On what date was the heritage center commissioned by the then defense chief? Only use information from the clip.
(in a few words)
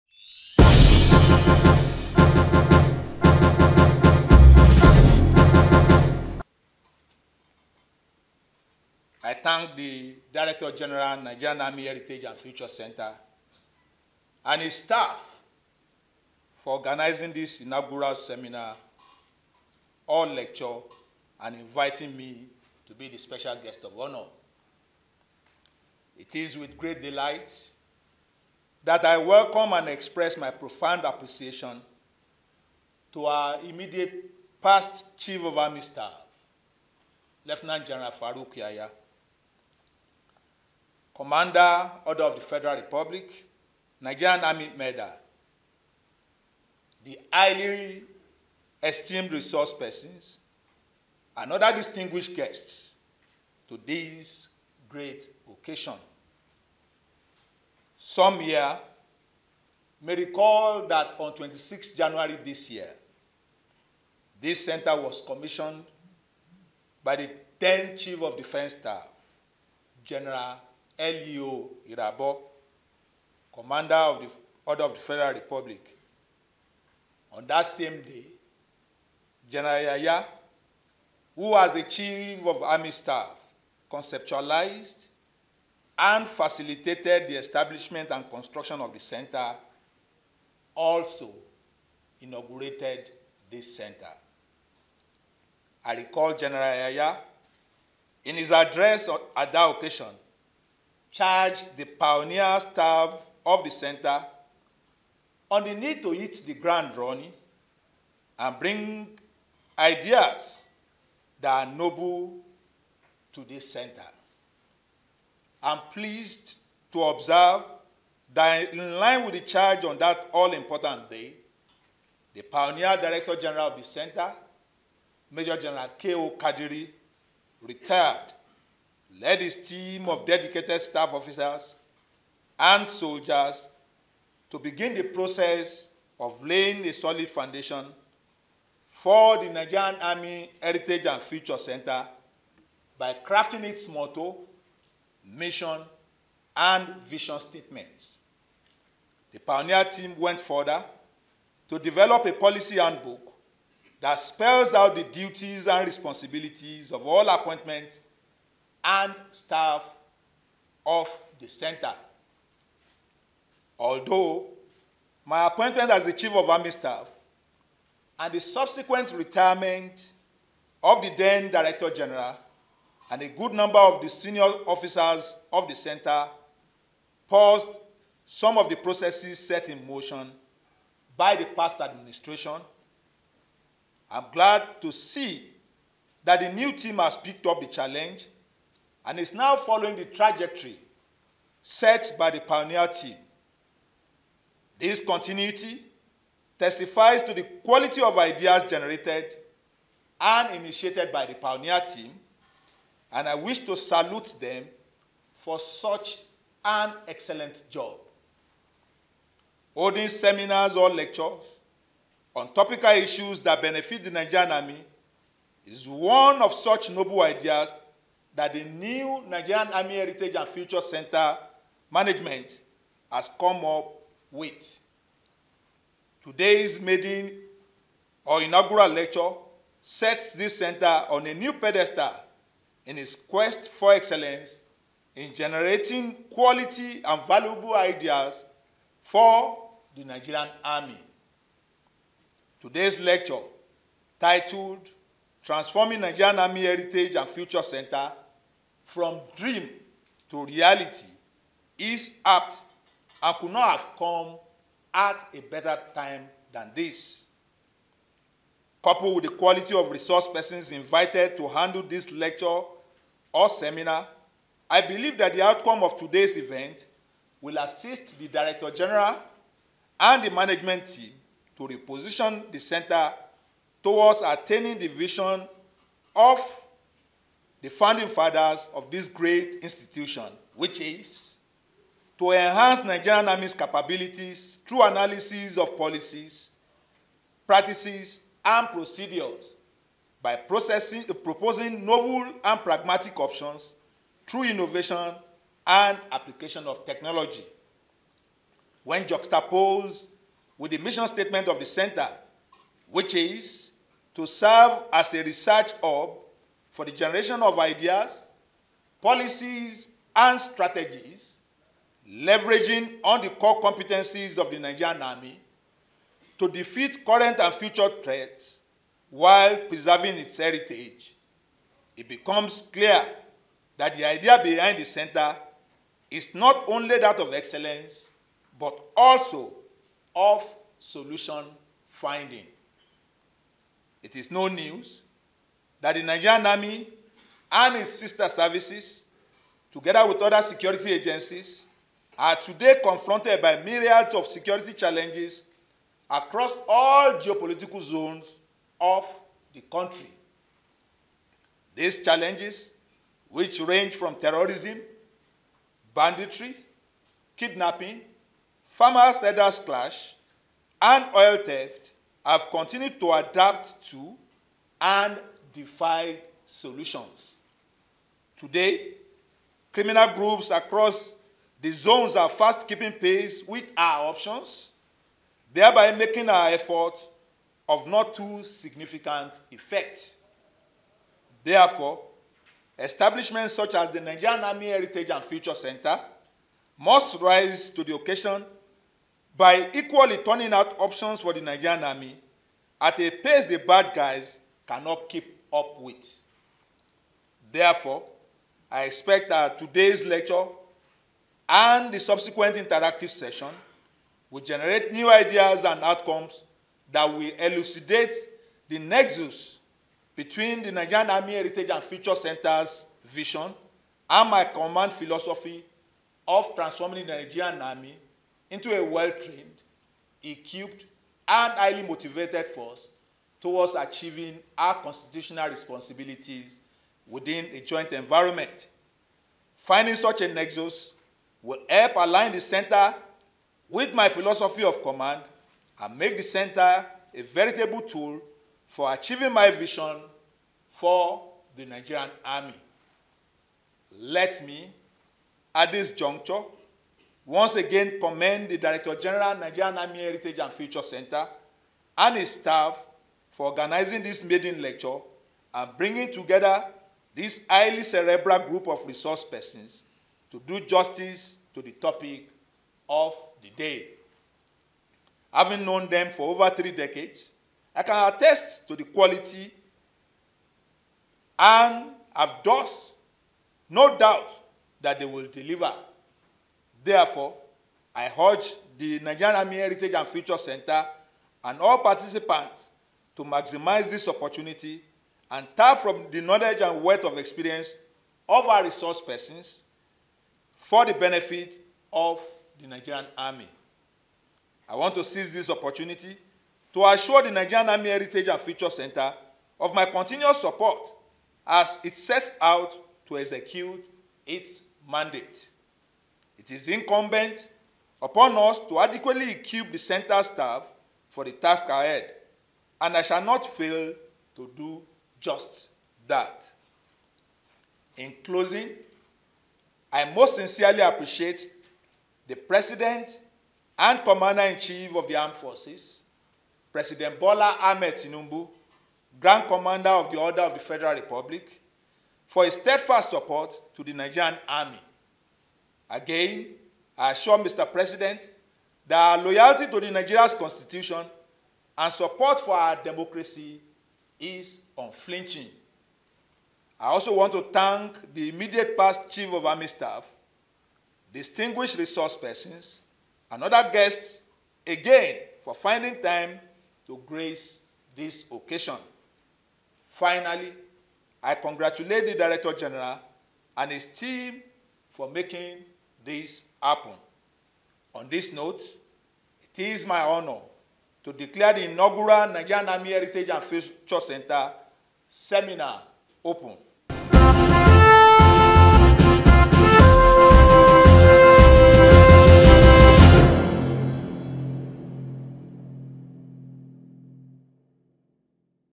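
26 January.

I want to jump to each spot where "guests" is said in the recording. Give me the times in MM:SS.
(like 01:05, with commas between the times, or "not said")
00:23, 00:52, 09:13.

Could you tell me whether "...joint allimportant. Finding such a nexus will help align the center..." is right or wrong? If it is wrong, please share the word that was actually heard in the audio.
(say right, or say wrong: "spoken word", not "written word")
wrong: "environment", not "allimportant".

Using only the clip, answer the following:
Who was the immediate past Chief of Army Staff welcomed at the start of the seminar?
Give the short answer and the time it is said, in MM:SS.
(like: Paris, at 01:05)
Farouk Yahaya, at 00:38.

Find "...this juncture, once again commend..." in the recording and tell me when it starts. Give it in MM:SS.
07:25.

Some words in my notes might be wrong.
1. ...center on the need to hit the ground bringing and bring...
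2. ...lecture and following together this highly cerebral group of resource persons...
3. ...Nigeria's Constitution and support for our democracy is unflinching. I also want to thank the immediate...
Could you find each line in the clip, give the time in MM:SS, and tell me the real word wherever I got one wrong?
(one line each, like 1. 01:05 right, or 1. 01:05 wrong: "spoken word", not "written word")
1. 01:43 wrong: "running", not "bringing"
2. 07:34 wrong: "bringing", not "following"
3. 08:59 right.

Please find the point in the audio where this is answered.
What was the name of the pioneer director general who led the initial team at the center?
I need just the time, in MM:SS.
02:05.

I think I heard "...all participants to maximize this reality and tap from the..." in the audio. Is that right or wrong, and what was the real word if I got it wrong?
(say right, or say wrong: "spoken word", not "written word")
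wrong: "opportunity", not "reality".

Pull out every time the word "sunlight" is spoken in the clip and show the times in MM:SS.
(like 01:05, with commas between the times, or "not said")
not said.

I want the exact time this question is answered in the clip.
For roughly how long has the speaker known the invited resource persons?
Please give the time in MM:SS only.
07:46.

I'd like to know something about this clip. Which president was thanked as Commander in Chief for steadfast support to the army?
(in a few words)
Bola Ahmed Tinubu.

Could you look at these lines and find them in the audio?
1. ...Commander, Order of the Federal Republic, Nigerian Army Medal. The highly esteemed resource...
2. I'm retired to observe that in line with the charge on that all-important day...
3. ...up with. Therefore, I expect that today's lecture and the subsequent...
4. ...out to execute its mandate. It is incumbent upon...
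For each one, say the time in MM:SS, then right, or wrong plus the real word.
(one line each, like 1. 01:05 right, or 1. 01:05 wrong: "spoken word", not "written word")
1. 00:41 right
2. 01:55 wrong: "pleased", not "retired"
3. 06:35 right
4. 08:22 right.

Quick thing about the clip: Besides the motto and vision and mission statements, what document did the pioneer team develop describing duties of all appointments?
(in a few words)
policy handbook.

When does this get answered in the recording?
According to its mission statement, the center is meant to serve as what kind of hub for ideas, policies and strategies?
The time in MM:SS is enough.
05:05.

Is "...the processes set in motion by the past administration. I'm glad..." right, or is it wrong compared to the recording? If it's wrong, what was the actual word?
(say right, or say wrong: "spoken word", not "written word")
right.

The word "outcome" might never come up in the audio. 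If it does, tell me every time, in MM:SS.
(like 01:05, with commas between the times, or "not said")
04:25, 06:45.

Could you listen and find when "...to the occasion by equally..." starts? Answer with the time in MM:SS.
06:27.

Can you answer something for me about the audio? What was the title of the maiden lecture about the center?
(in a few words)
from dream to reality.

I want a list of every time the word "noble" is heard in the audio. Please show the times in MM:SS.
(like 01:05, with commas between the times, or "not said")
01:51, 03:36.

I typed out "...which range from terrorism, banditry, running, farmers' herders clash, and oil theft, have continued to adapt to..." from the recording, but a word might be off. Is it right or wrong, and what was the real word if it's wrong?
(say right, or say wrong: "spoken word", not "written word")
wrong: "kidnapping", not "running".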